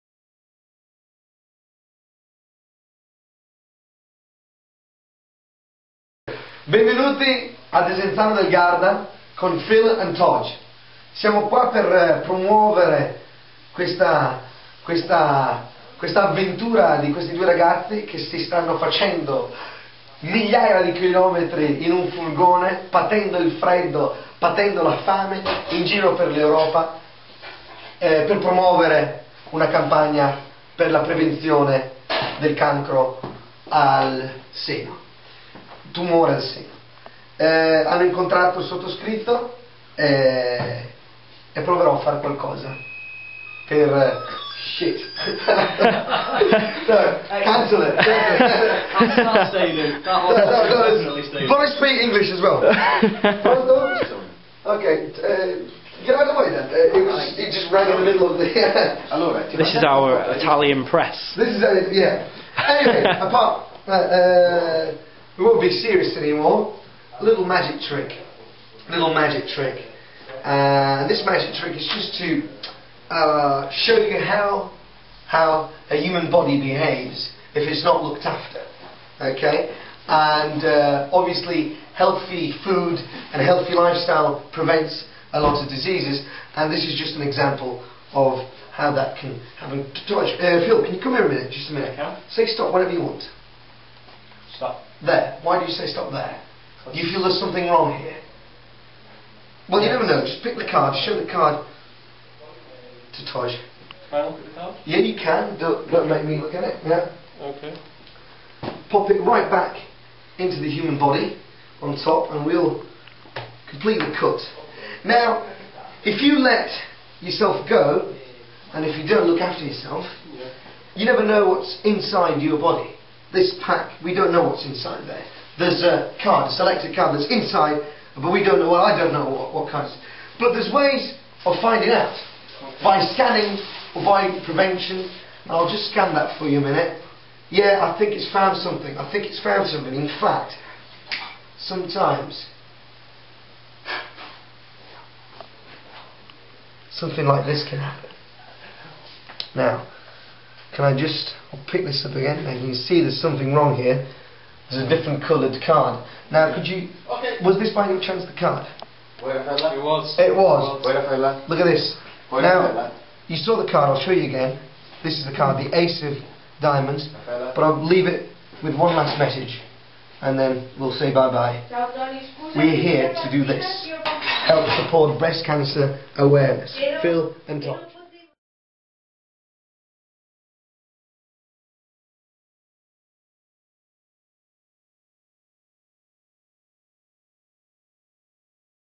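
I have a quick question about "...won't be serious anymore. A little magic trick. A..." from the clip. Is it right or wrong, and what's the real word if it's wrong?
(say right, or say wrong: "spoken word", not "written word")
right.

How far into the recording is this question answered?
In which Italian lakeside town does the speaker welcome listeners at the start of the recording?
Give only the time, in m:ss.
0:07.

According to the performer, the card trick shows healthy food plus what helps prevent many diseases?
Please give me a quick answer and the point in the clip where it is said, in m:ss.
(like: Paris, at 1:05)
healthy lifestyle, at 1:23.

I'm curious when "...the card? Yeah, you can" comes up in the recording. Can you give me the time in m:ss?
1:44.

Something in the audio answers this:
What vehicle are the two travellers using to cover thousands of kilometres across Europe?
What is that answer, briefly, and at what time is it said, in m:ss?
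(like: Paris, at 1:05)
furgone, at 0:22.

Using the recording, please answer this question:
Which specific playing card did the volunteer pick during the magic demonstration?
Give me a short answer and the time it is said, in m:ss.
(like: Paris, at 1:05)
ace of diamonds, at 2:45.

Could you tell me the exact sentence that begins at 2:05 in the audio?
There's a card, a selected card that's inside, but we don't know, well, I don't know what, what cards.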